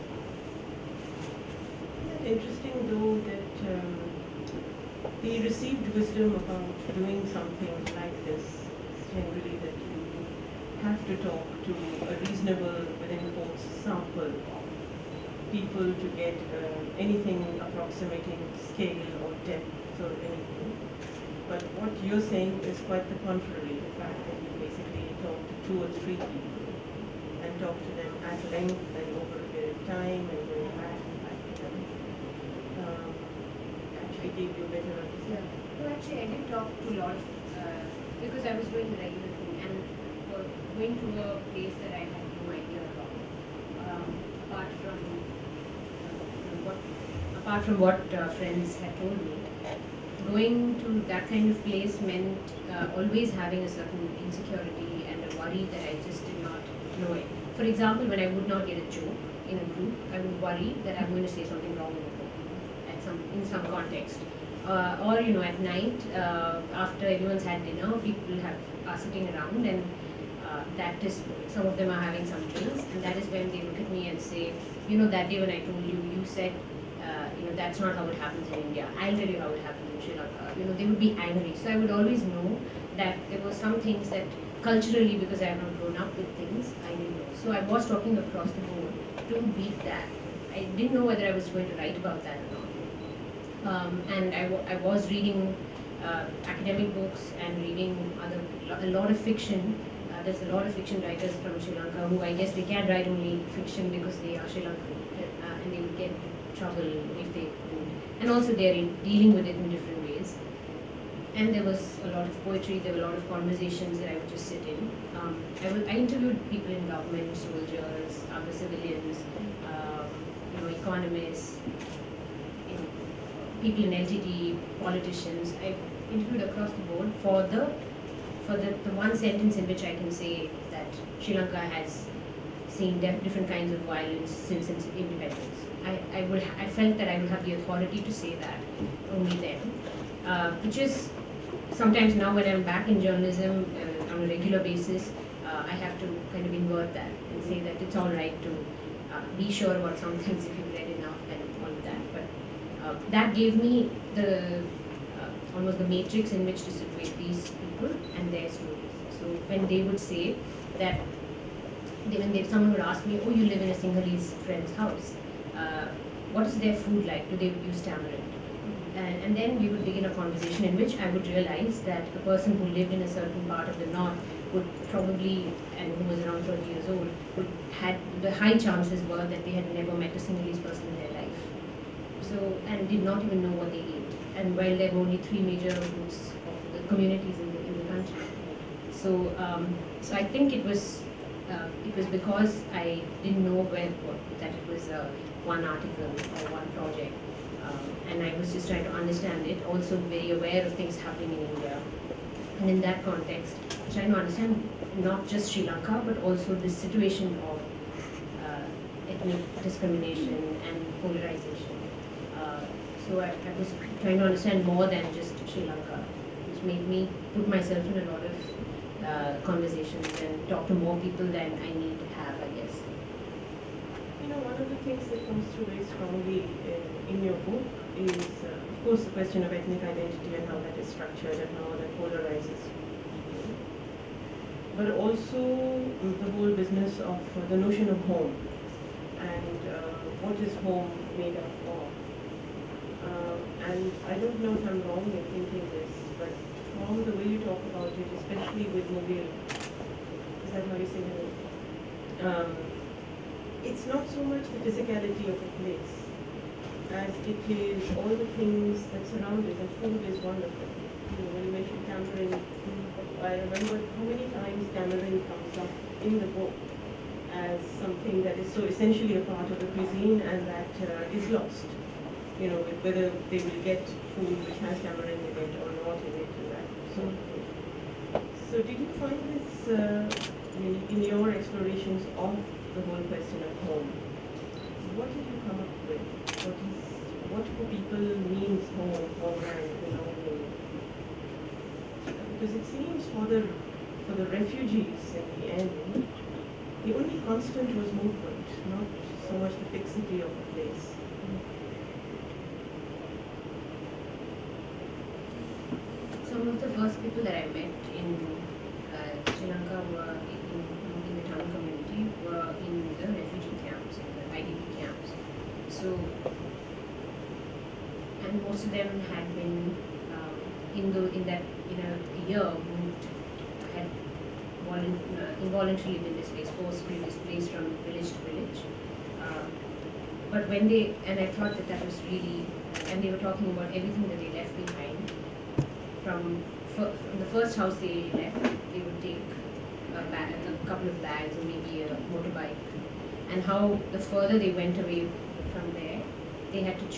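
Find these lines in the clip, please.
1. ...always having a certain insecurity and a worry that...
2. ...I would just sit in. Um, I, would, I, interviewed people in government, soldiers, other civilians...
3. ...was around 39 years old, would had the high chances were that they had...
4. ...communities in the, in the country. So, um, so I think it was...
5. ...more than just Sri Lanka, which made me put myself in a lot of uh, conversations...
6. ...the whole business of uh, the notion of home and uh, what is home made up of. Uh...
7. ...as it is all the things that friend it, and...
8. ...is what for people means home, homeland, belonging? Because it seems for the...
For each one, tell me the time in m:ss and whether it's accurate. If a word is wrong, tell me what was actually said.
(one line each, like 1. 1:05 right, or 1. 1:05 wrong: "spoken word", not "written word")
1. 0:52 right
2. 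1:54 right
3. 2:56 wrong: "30", not "39"
4. 3:06 right
5. 3:34 right
6. 3:55 right
7. 4:16 wrong: "surround", not "friend"
8. 4:46 right.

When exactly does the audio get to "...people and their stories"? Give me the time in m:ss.
2:37.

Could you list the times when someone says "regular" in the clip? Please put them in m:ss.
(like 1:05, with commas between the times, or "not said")
0:39, 2:24.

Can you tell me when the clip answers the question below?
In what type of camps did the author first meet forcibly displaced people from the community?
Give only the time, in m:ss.
5:14.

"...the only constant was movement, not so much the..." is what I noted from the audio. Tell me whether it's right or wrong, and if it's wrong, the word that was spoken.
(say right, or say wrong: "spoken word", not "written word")
right.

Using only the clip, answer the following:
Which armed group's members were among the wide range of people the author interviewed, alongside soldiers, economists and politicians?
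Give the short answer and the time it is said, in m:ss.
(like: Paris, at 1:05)
LTTE, at 2:04.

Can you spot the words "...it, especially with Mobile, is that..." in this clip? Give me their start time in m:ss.
4:07.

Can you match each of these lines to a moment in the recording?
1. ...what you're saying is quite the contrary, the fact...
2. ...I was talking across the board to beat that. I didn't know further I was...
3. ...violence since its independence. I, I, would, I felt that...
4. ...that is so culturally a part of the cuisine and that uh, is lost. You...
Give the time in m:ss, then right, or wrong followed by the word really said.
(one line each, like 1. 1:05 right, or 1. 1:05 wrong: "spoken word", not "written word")
1. 0:21 right
2. 1:27 wrong: "whether", not "further"
3. 2:13 right
4. 4:28 wrong: "essentially", not "culturally".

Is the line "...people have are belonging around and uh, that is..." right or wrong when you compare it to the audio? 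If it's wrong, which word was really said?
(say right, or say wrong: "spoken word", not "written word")
wrong: "sitting", not "belonging".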